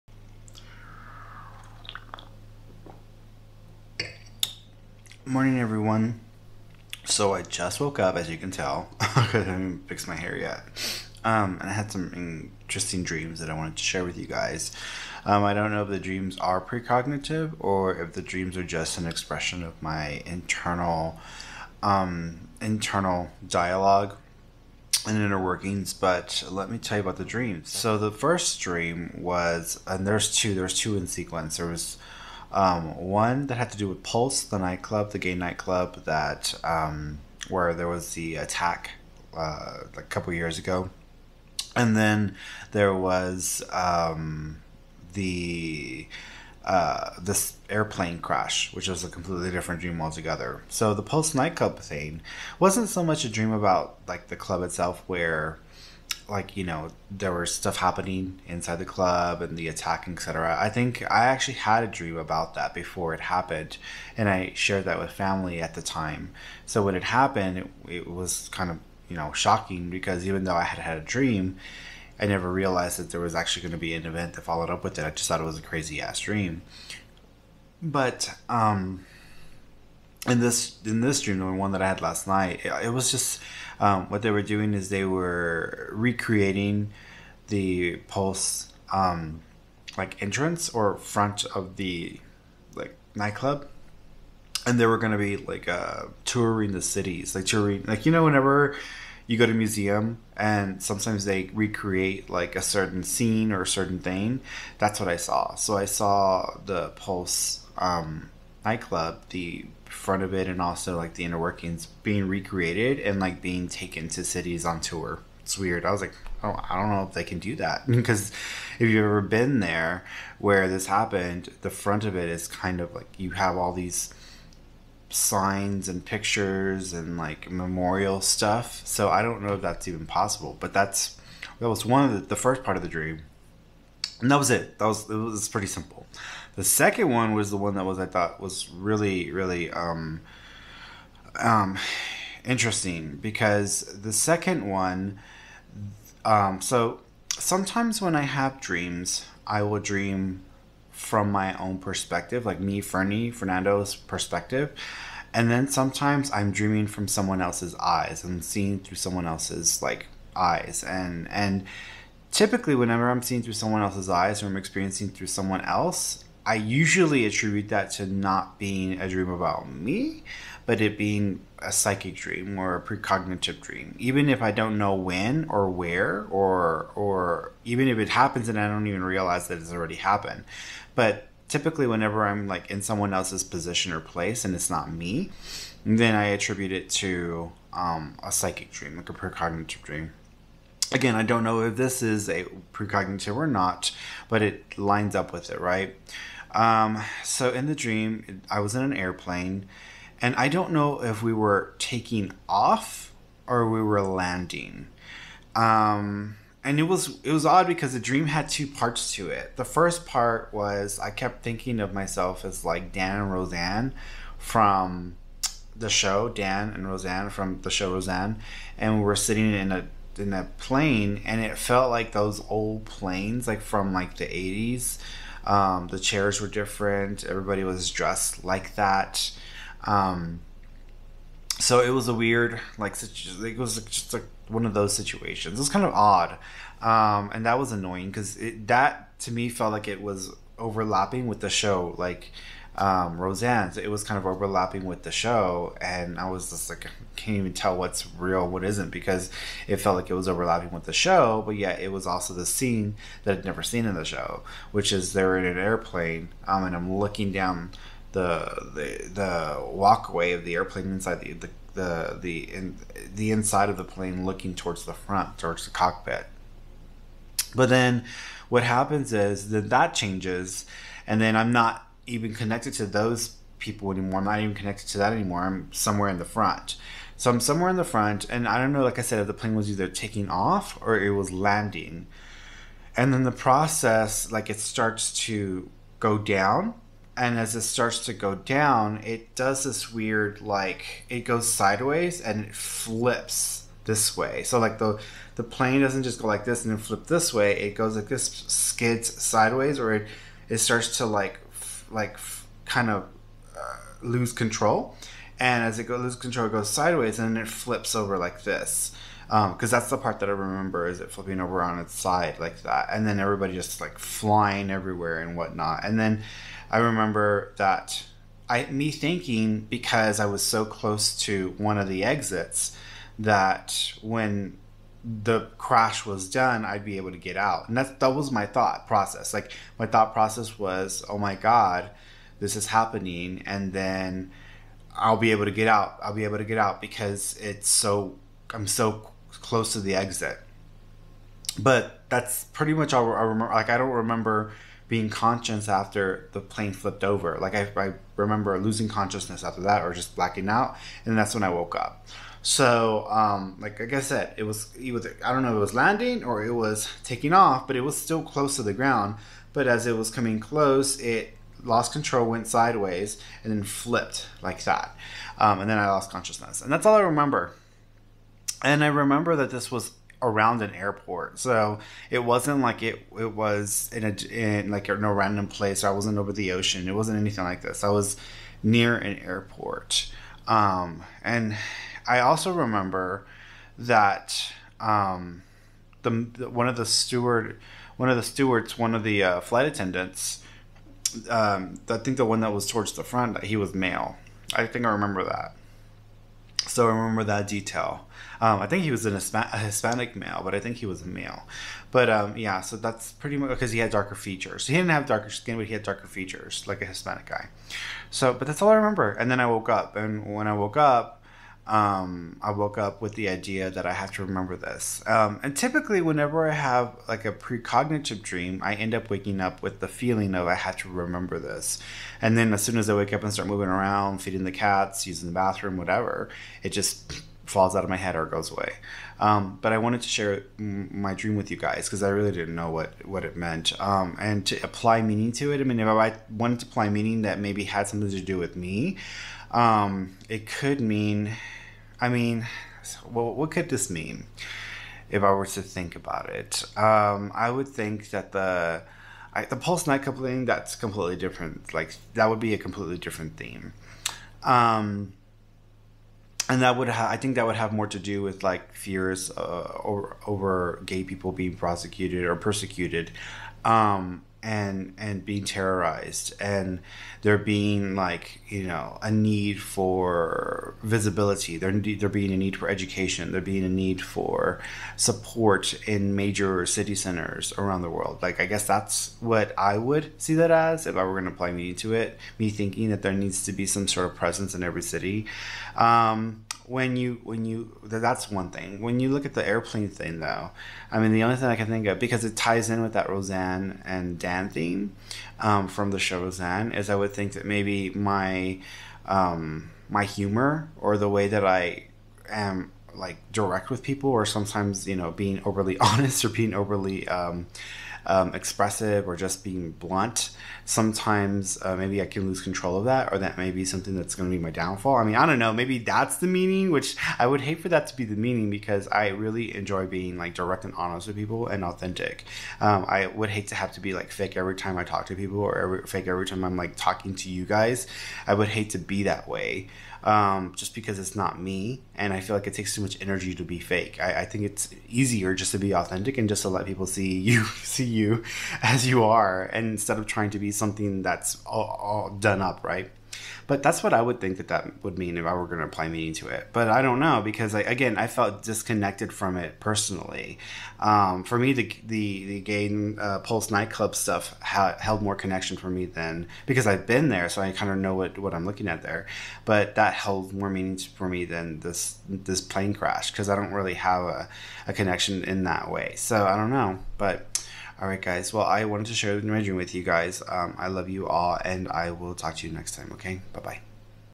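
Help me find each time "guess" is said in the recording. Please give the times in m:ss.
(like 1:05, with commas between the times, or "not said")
7:58.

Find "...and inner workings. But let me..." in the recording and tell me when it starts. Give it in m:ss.
0:25.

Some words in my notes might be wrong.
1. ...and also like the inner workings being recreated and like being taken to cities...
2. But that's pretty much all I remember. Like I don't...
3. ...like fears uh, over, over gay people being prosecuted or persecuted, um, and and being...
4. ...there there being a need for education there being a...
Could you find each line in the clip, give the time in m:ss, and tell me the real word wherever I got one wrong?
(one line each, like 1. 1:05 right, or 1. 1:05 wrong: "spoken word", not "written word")
1. 1:50 right
2. 5:41 right
3. 7:38 right
4. 7:51 right.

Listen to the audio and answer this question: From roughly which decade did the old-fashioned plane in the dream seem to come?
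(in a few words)
The eighties.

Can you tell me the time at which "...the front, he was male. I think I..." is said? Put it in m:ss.
6:32.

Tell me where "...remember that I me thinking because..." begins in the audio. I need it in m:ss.
5:16.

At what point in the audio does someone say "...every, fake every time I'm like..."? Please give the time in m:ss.
8:45.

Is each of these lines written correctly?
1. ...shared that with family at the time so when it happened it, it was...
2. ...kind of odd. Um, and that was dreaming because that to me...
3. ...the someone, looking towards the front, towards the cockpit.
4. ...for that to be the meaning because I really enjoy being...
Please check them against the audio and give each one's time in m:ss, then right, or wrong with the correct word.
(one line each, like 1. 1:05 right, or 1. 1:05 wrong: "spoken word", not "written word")
1. 1:04 right
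2. 3:55 wrong: "annoying", not "dreaming"
3. 4:23 wrong: "plane", not "someone"
4. 8:37 right.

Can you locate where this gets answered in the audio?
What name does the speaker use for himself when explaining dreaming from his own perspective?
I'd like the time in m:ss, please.
2:32.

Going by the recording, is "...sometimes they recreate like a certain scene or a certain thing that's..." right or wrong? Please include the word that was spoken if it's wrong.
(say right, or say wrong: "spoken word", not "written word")
right.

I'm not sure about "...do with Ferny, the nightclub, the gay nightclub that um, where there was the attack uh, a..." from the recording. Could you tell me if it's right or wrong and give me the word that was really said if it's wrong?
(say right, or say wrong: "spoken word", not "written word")
wrong: "Pulse", not "Ferny".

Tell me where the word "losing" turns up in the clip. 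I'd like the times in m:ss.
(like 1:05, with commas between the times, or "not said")
5:48.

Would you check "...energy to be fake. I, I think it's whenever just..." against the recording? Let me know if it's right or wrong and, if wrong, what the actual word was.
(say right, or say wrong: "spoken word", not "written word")
wrong: "easier", not "whenever".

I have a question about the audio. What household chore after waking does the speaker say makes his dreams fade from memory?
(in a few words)
Feeding the cats.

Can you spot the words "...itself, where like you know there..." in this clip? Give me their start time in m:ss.
0:54.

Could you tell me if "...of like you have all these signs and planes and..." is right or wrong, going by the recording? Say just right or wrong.
wrong.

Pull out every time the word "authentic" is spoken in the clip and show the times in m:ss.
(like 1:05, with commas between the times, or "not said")
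8:41, 8:55.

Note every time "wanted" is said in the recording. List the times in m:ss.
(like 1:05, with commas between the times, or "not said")
0:13, 7:09, 7:16, 9:28.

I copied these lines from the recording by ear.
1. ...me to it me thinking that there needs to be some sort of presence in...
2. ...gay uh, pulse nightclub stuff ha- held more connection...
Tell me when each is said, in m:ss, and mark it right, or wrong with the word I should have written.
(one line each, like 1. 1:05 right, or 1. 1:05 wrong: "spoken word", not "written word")
1. 8:01 right
2. 9:12 right.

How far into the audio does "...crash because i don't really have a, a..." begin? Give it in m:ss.
9:22.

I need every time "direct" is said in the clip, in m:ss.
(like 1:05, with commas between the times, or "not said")
8:23, 8:40.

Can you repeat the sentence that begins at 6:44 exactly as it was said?
He didn't have darker skin, but he had darker features, like a Hispanic guy.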